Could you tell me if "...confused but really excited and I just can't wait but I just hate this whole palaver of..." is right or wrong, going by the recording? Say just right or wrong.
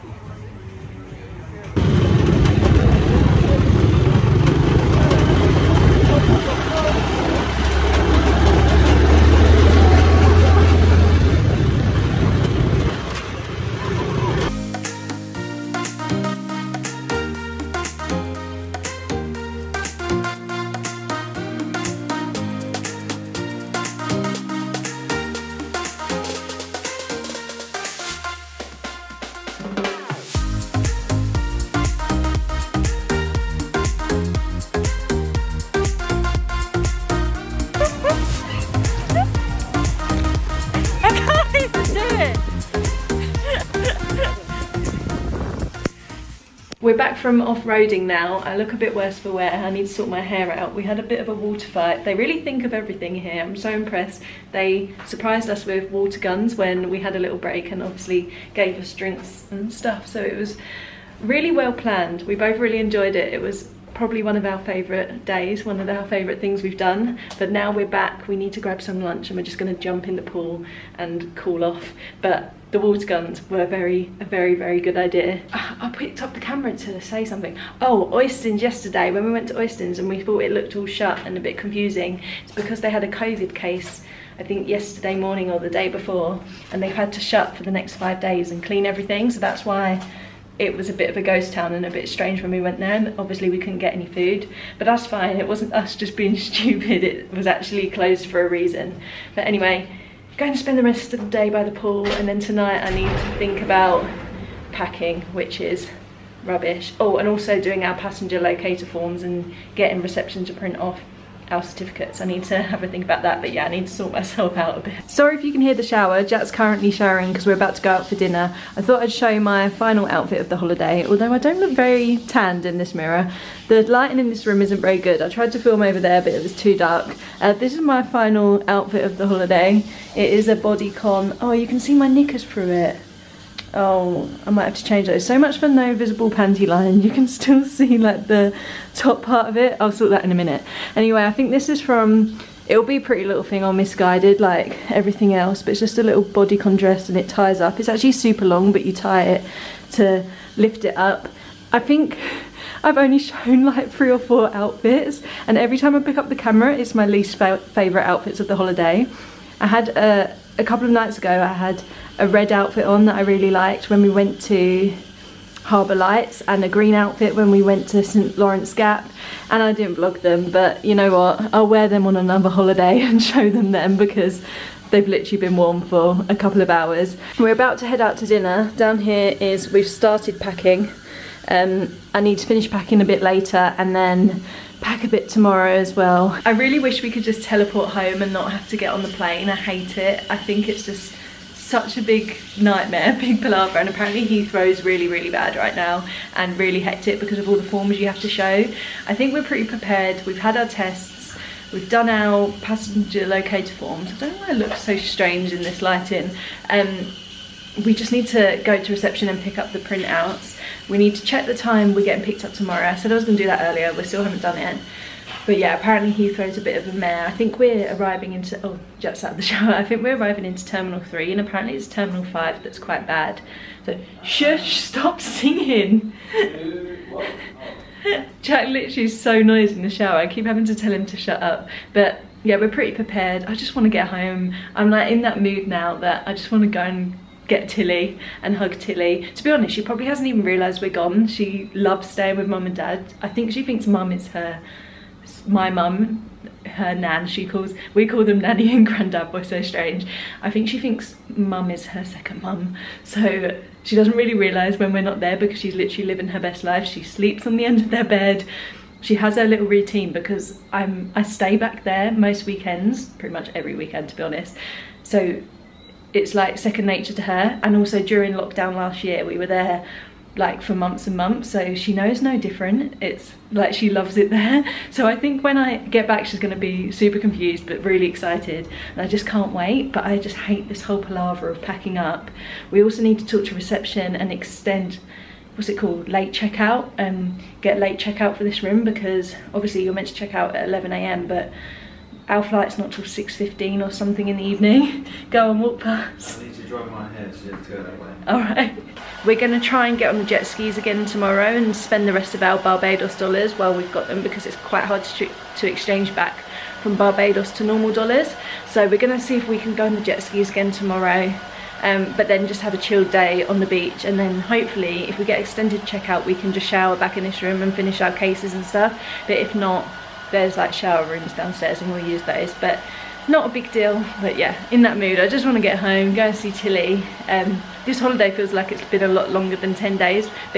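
right.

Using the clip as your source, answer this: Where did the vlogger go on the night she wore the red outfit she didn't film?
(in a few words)
Harbour Lights.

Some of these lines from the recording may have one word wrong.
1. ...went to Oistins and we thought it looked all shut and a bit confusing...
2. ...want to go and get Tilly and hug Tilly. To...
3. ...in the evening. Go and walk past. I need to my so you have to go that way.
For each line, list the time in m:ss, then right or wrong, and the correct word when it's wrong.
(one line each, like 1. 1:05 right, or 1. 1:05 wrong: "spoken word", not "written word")
1. 1:19 right
2. 3:56 right
3. 4:54 right.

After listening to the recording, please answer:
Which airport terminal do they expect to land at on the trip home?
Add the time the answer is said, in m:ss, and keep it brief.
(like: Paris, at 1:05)
Terminal 3, at 3:40.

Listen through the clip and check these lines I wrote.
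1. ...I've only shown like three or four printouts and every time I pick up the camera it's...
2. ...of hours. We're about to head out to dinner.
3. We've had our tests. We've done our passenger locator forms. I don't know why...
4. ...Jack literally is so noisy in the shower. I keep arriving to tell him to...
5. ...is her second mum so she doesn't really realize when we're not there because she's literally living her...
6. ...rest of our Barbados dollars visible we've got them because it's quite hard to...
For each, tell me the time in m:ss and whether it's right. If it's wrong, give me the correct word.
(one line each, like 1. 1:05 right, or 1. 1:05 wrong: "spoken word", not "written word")
1. 2:32 wrong: "outfits", not "printouts"
2. 2:56 right
3. 3:20 right
4. 3:48 wrong: "having", not "arriving"
5. 4:11 right
6. 5:02 wrong: "while", not "visible".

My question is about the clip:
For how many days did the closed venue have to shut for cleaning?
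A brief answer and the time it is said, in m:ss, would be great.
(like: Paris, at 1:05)
5, at 1:27.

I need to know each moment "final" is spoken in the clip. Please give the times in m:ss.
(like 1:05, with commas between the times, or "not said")
1:59, 2:08.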